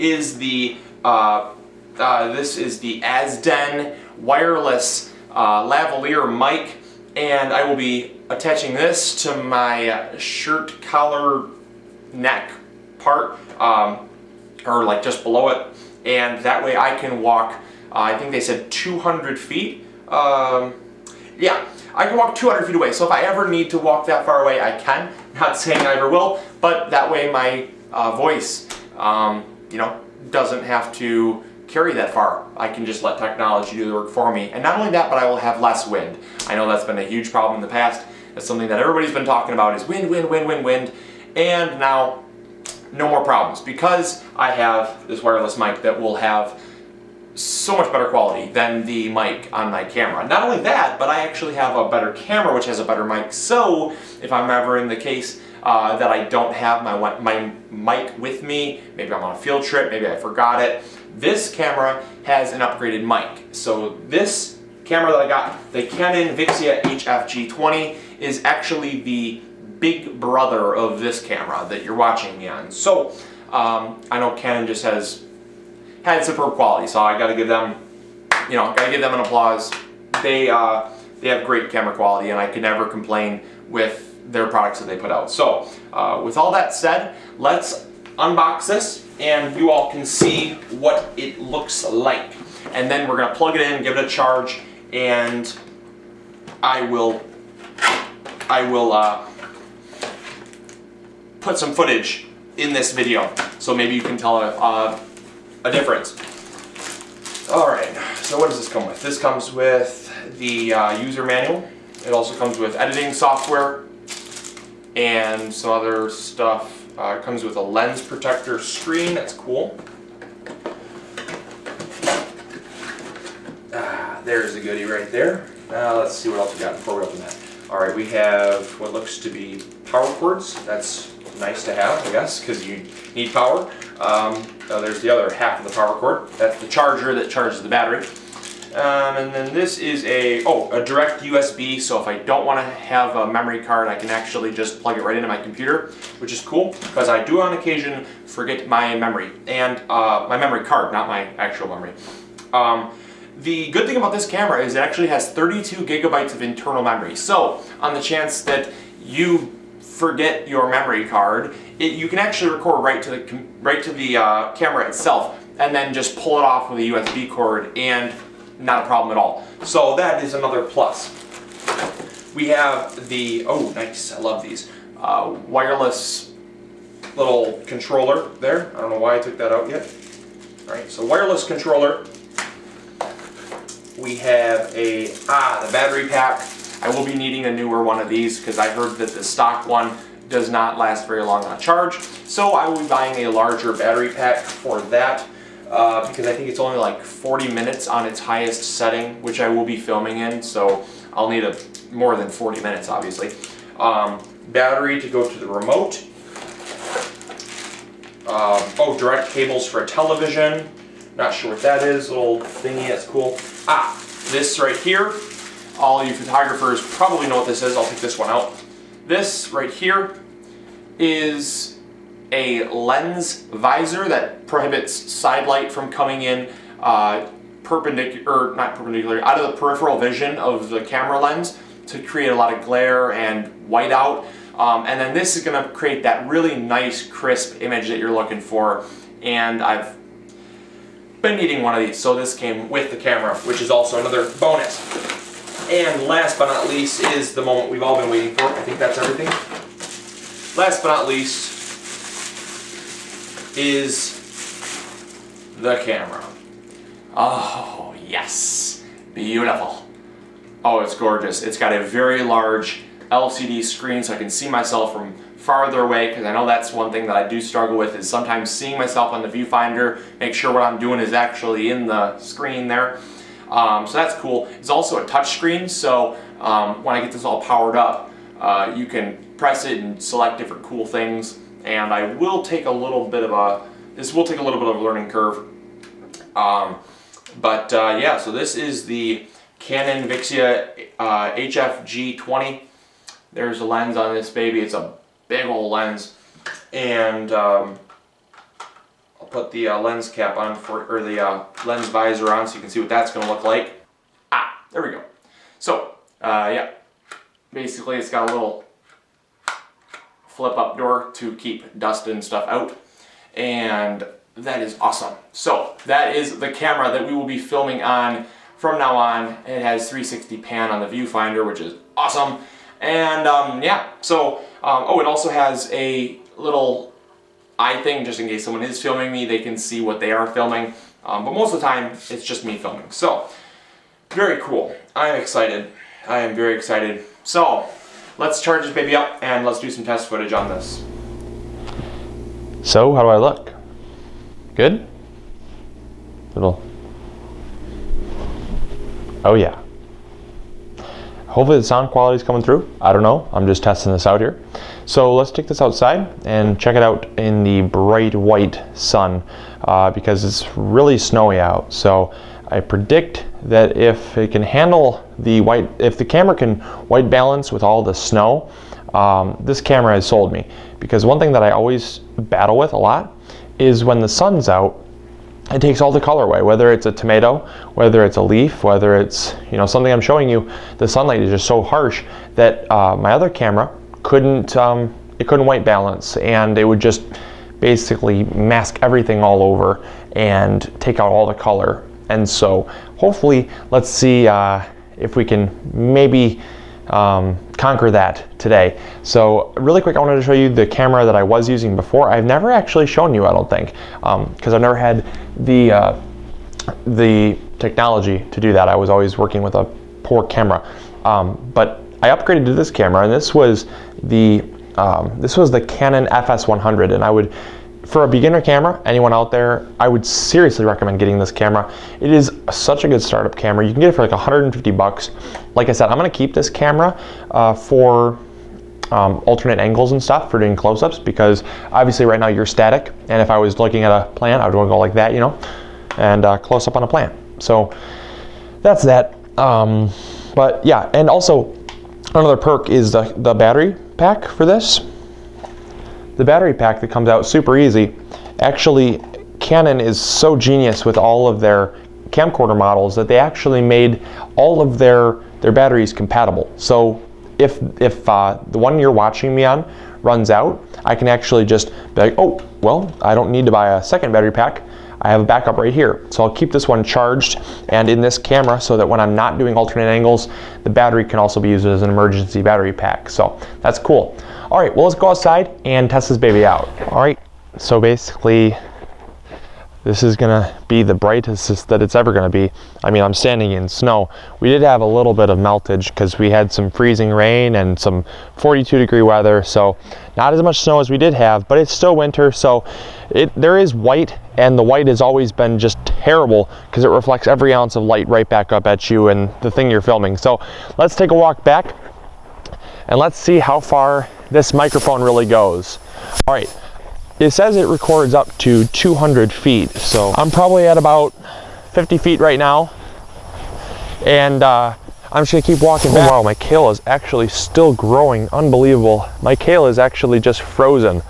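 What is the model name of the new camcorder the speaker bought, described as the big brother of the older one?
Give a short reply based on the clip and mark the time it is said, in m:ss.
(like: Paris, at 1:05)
Canon Vixia HFG20, at 1:05.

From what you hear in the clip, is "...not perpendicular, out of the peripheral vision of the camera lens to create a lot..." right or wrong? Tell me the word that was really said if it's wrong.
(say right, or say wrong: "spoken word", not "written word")
right.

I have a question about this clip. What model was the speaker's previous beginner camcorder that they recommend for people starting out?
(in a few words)
Canon FS100.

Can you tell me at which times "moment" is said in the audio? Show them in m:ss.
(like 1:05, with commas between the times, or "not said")
4:07.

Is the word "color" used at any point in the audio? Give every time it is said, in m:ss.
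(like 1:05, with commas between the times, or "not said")
6:16, 6:31.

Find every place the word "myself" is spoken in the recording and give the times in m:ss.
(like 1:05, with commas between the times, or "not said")
4:24, 4:28.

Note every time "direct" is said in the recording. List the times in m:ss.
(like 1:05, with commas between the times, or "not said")
2:20, 3:28.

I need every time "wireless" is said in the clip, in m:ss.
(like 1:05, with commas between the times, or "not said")
0:04, 0:45, 2:55, 3:01.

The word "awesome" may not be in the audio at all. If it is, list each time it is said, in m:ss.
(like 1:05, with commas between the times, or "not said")
5:14, 5:21.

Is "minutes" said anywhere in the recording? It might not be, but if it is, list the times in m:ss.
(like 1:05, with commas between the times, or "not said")
3:17, 3:22.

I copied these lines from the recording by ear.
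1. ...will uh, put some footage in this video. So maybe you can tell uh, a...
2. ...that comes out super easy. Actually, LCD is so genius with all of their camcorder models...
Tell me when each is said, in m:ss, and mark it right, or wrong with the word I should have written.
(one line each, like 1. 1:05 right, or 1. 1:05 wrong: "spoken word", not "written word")
1. 1:38 right
2. 7:26 wrong: "Canon", not "LCD".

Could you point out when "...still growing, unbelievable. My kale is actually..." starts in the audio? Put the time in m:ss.
8:37.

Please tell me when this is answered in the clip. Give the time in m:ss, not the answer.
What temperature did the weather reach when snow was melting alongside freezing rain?
8:08.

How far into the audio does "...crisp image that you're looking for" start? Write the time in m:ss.
3:57.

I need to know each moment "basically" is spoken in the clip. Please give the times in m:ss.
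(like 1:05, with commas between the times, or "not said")
5:07, 6:27, 7:57.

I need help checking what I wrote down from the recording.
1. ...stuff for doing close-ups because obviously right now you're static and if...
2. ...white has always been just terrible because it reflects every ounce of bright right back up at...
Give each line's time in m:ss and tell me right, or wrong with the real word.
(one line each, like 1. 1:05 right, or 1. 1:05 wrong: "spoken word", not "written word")
1. 7:10 right
2. 8:14 wrong: "light", not "bright".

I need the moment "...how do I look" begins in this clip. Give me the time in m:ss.
5:42.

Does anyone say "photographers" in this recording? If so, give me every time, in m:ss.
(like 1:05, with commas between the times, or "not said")
3:36.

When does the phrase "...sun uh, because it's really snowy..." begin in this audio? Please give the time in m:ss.
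5:58.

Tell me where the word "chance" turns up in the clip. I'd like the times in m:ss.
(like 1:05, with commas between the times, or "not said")
2:38.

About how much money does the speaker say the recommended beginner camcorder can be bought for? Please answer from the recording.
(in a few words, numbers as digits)
$150.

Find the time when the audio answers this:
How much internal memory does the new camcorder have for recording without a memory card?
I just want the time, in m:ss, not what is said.
2:35.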